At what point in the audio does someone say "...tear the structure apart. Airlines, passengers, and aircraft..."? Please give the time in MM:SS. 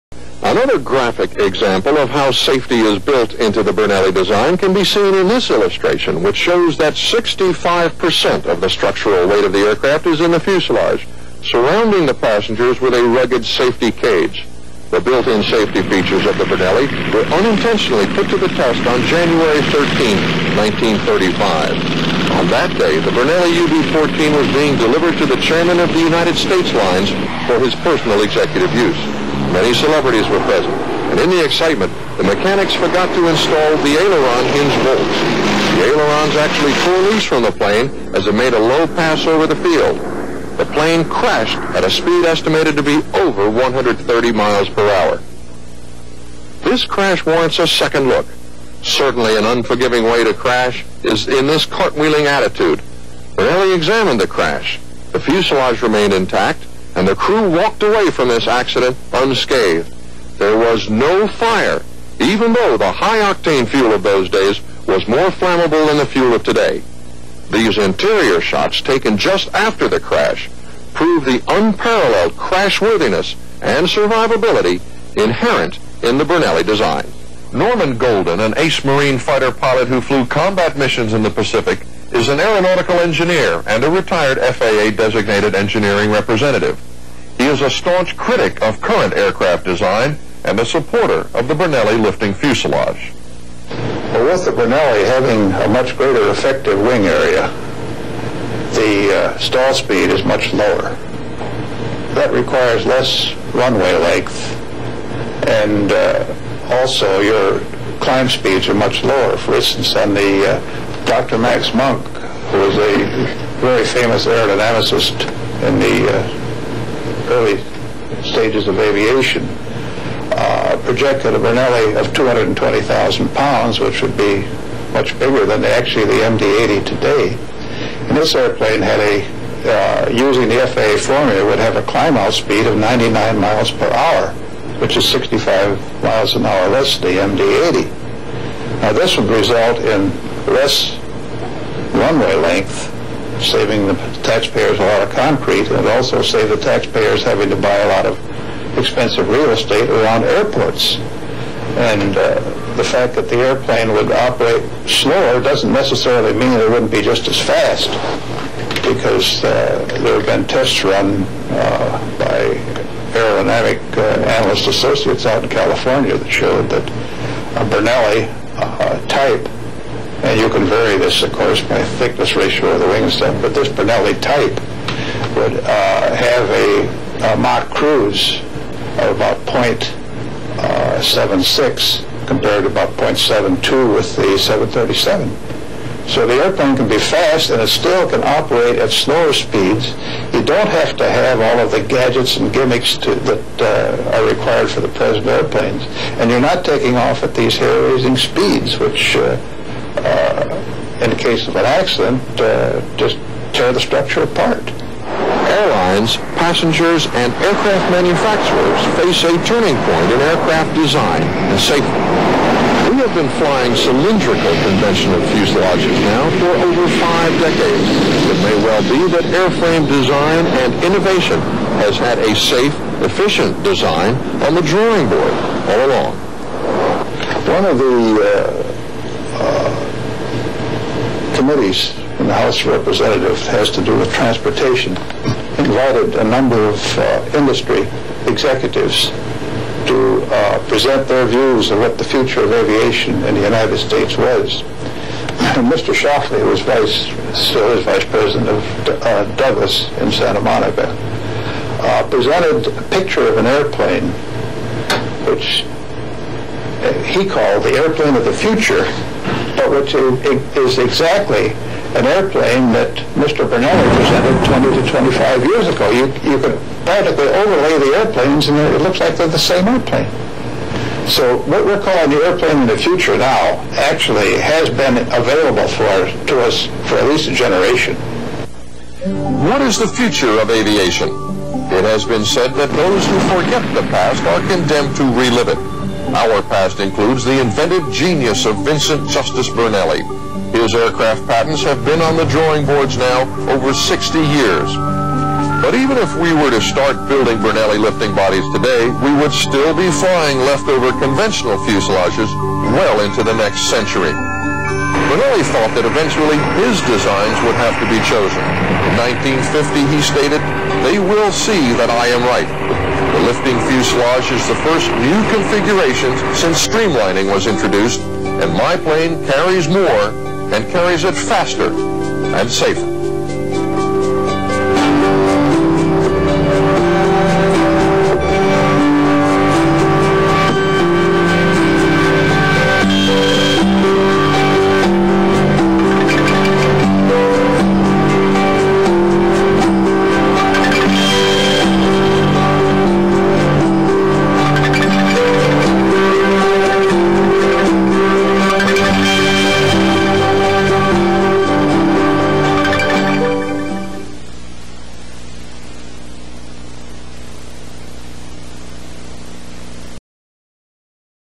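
03:23.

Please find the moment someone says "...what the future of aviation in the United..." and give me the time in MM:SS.
04:01.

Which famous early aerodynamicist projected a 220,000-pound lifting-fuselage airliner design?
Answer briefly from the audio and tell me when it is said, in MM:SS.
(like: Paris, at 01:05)
Max Munk, at 01:51.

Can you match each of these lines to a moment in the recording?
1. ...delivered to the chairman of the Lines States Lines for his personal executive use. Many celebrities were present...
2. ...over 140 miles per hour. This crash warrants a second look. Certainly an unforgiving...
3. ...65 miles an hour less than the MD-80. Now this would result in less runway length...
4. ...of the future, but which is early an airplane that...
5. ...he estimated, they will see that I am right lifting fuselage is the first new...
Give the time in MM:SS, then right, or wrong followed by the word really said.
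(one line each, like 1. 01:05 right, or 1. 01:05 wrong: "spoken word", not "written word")
1. 00:24 wrong: "United", not "Lines"
2. 00:43 wrong: "130", not "140"
3. 02:15 right
4. 04:18 wrong: "exactly", not "early"
5. 05:09 wrong: "stated", not "estimated".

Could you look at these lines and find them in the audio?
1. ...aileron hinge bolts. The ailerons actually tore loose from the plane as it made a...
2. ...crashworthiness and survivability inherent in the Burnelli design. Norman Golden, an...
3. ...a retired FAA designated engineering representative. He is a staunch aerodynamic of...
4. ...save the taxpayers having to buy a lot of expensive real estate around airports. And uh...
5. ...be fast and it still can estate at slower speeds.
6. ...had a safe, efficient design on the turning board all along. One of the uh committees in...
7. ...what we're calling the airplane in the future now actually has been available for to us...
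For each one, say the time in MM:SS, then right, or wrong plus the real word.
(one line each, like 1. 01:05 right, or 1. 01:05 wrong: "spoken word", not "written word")
1. 00:33 right
2. 01:12 right
3. 01:23 wrong: "critic", not "aerodynamic"
4. 02:26 right
5. 03:06 wrong: "operate", not "estate"
6. 03:41 wrong: "drawing", not "turning"
7. 04:31 right.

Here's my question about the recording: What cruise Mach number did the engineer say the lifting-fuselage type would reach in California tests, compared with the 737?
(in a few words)
0.76.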